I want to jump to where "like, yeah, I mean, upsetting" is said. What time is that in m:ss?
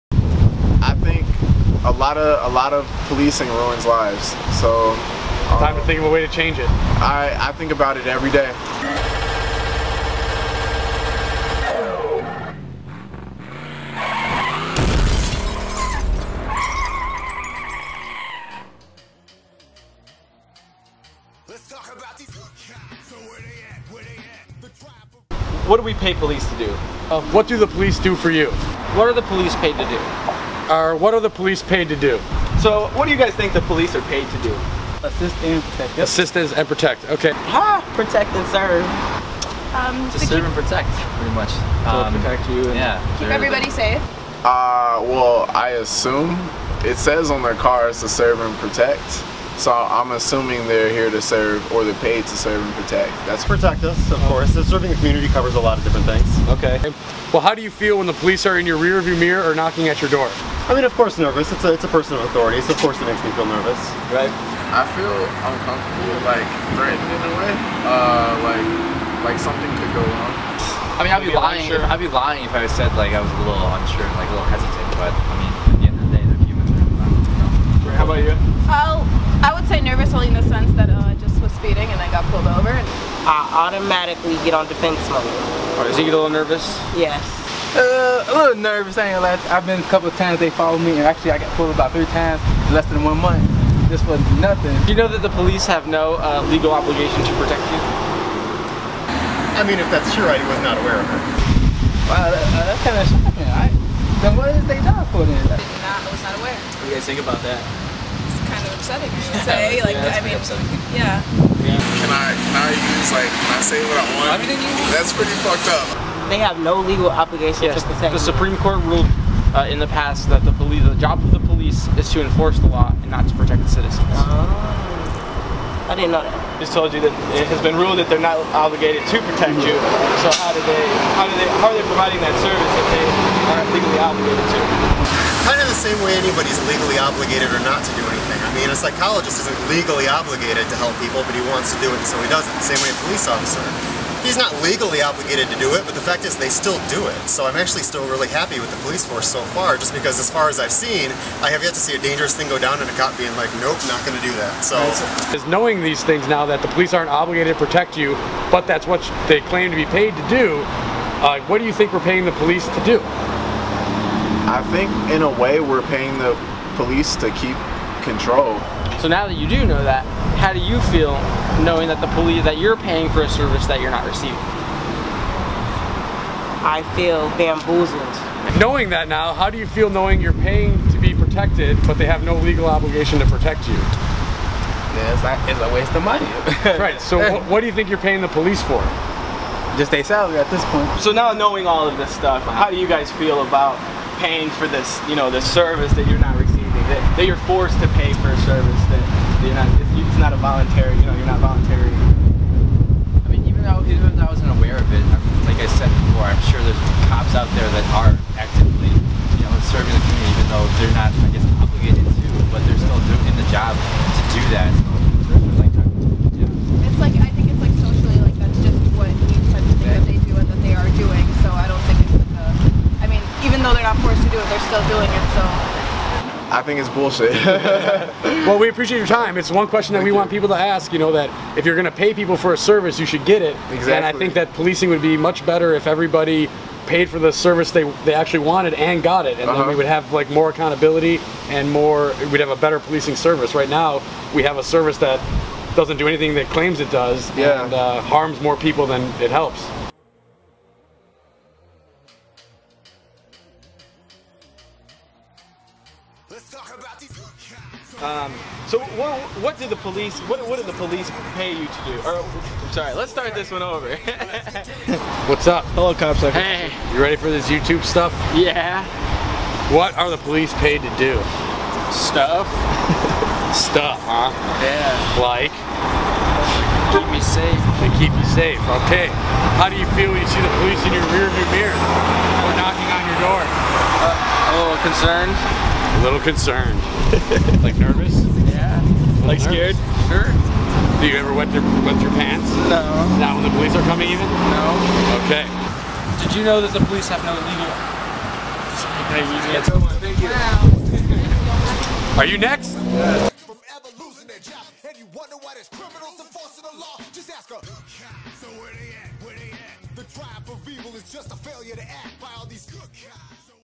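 1:49.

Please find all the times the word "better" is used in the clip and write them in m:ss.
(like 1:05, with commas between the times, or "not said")
3:55, 4:02.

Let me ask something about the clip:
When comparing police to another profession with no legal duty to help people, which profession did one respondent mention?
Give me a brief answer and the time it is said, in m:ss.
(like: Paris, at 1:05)
Psychologist, at 2:18.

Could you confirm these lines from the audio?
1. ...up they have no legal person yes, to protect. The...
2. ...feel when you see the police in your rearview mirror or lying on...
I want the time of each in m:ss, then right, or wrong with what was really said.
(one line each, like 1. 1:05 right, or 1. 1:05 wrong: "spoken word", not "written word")
1. 1:55 wrong: "obligation", not "person"
2. 4:39 wrong: "knocking", not "lying".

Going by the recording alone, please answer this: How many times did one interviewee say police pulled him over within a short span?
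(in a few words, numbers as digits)
3.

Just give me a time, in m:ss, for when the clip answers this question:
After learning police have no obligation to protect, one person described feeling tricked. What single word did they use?
2:57.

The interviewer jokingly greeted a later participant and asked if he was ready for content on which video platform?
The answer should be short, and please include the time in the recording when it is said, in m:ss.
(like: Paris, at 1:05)
YouTube, at 4:27.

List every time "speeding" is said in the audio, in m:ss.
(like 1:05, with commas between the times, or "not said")
1:21.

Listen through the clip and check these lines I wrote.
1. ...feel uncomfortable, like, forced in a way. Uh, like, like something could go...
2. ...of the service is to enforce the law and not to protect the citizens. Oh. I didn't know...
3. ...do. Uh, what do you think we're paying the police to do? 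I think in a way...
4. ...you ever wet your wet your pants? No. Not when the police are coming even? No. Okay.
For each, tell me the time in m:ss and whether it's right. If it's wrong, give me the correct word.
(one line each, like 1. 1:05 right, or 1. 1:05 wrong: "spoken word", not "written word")
1. 1:04 wrong: "threatened", not "forced"
2. 2:01 wrong: "police", not "service"
3. 2:40 right
4. 4:51 right.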